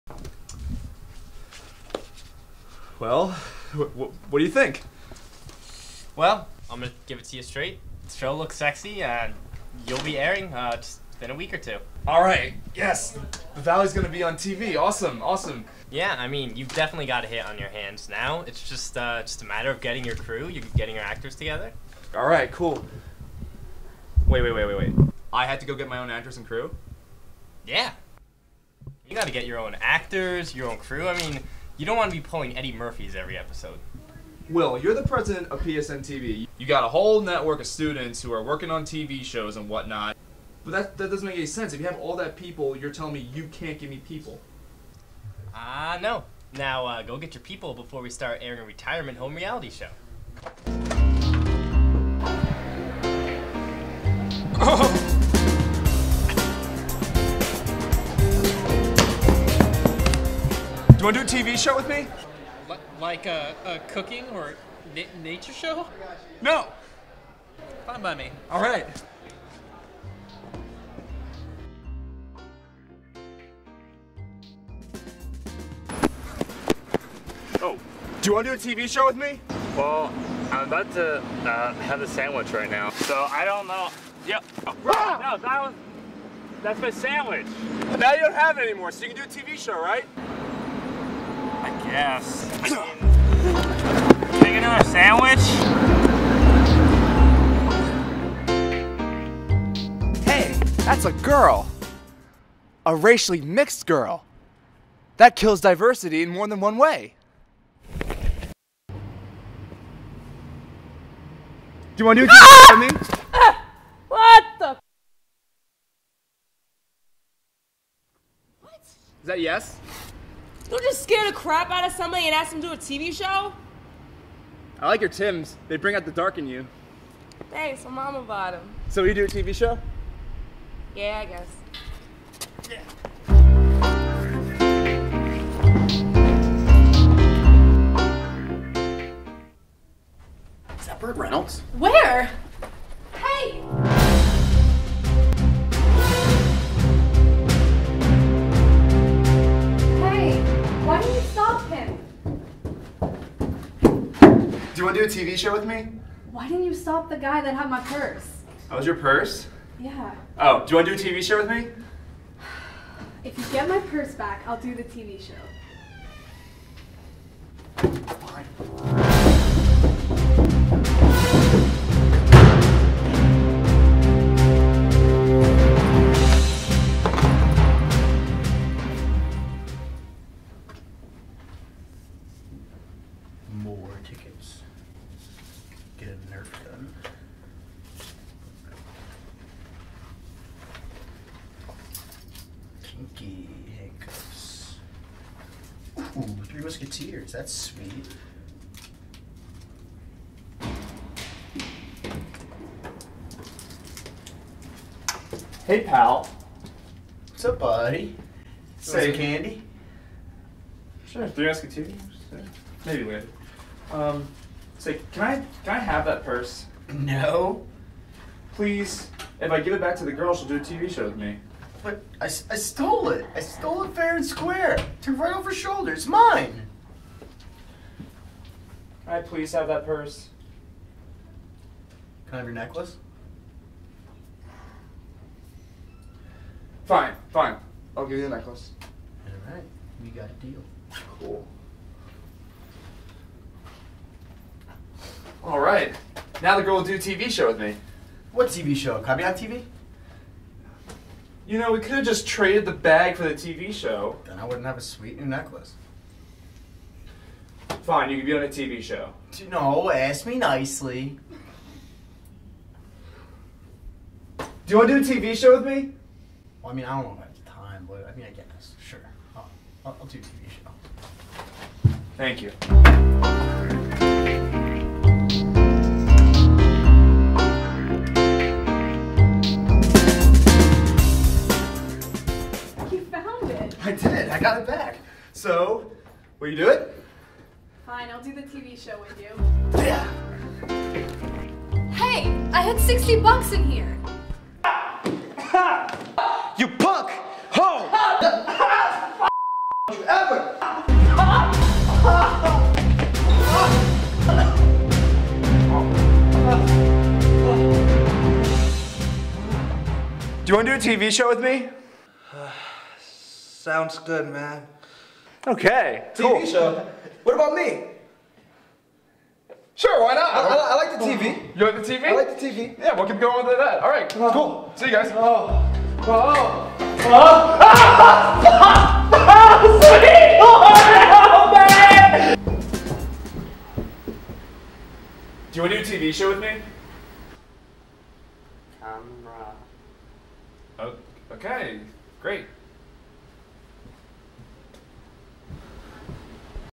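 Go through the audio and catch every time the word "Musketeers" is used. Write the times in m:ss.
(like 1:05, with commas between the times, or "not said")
3:16, 3:31.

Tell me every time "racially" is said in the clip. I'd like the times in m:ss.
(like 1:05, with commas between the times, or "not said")
1:42.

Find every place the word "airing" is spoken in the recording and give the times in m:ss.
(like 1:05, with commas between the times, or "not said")
0:10, 0:48.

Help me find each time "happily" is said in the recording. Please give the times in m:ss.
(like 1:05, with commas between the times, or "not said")
not said.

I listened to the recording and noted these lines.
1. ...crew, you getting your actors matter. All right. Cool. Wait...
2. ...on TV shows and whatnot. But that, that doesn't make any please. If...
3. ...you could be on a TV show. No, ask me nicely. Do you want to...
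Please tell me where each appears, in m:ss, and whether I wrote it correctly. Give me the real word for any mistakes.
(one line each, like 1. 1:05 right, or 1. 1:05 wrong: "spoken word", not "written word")
1. 0:20 wrong: "together", not "matter"
2. 0:38 wrong: "sense", not "please"
3. 4:18 right.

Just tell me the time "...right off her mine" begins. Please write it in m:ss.
3:45.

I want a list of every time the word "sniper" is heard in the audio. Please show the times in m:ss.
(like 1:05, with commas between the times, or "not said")
not said.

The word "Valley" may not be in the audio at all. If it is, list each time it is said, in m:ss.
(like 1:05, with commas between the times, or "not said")
0:13.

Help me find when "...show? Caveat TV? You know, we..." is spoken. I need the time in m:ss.
4:08.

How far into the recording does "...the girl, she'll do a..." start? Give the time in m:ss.
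3:40.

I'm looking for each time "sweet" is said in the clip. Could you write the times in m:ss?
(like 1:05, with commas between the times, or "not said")
3:17, 4:14.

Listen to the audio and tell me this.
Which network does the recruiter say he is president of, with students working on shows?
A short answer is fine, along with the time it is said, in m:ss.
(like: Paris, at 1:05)
PSN TV, at 0:35.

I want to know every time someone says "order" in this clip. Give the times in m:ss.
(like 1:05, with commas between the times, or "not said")
not said.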